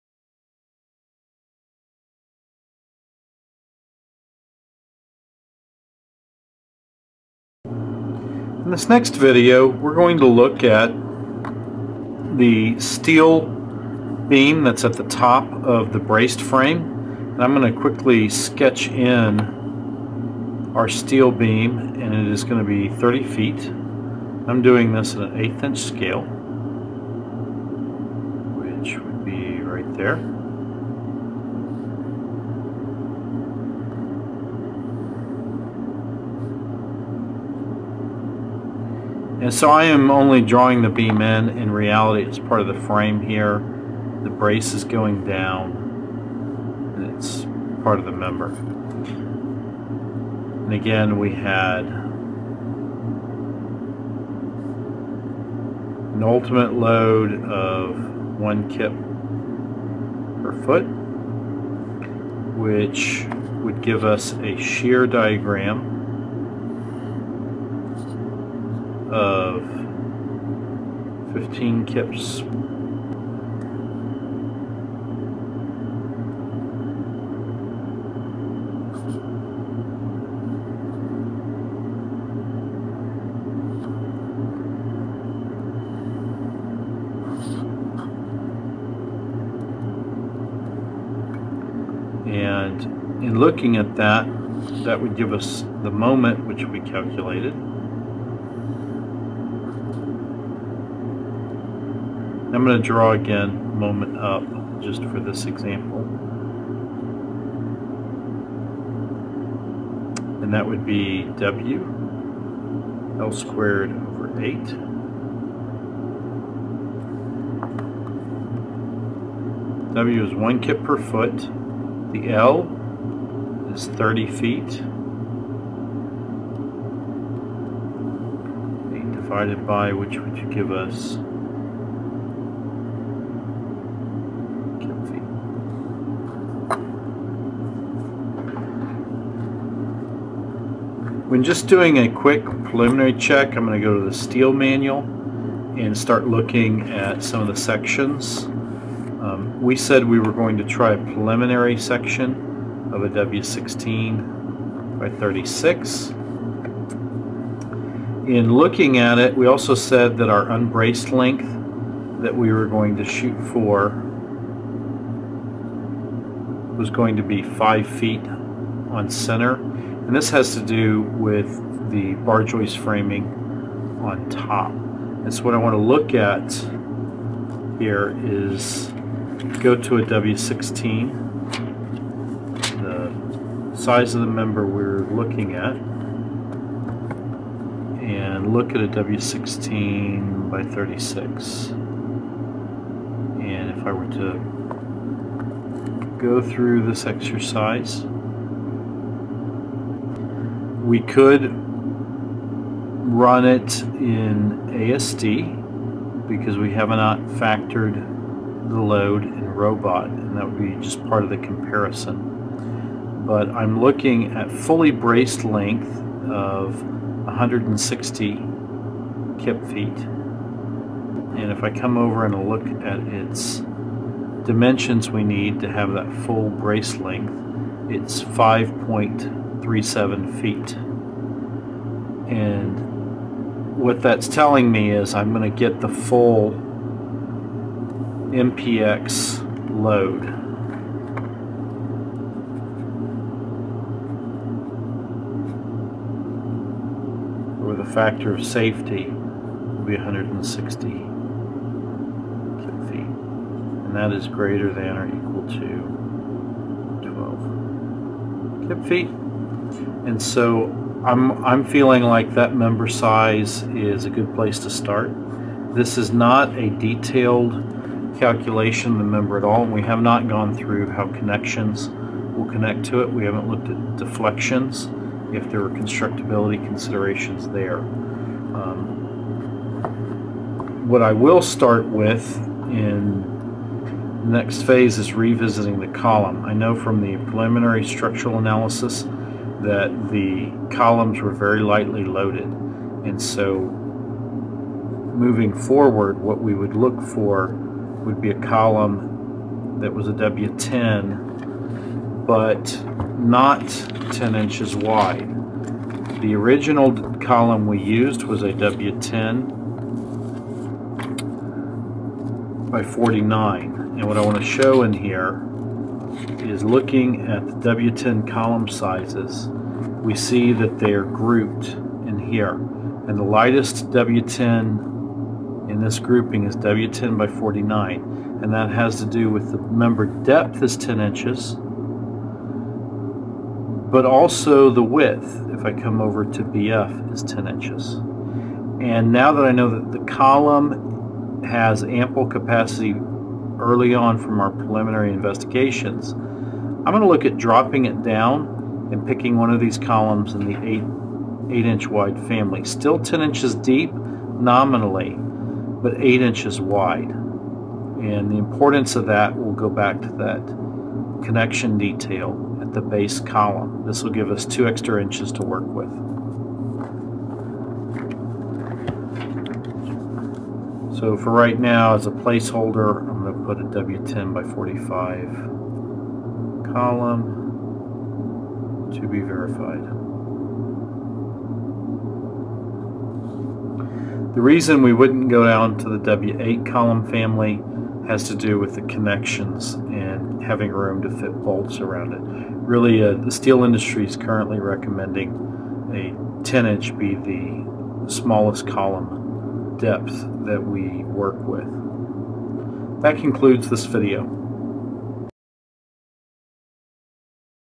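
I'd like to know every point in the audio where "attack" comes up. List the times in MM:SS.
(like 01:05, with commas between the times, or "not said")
not said.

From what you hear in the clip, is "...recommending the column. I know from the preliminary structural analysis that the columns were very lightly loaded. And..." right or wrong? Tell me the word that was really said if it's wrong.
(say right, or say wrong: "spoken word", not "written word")
wrong: "revisiting", not "recommending".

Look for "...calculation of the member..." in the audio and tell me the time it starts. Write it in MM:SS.
04:28.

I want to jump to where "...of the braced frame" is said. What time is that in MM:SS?
00:15.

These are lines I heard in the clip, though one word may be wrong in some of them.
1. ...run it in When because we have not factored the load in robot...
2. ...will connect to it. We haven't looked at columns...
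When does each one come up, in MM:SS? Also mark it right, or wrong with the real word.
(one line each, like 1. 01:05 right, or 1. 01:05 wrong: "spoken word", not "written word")
1. 03:21 wrong: "ASD", not "When"
2. 04:32 wrong: "deflections", not "columns".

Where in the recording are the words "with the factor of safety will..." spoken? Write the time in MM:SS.
04:07.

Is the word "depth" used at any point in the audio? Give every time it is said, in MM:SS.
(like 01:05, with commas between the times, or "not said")
05:30, 06:39.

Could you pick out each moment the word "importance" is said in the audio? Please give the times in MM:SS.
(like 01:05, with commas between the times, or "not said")
05:58.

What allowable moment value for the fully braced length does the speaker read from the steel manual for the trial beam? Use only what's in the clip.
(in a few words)
160 kip feet.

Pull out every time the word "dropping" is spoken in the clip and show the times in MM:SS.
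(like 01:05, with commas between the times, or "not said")
05:47.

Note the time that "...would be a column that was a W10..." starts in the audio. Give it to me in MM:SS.
04:58.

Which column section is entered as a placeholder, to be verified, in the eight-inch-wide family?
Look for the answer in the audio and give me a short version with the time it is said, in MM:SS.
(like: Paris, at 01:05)
W10 by 45, at 06:13.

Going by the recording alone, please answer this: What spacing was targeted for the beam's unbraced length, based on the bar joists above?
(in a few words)
5 feet on center.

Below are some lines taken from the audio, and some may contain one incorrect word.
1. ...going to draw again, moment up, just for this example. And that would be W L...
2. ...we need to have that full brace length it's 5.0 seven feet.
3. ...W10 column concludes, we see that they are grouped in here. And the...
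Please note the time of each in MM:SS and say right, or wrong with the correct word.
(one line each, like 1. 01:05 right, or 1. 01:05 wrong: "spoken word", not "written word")
1. 01:42 right
2. 03:45 right
3. 05:17 wrong: "sizes", not "concludes".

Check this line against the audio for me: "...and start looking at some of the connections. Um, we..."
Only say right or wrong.
wrong.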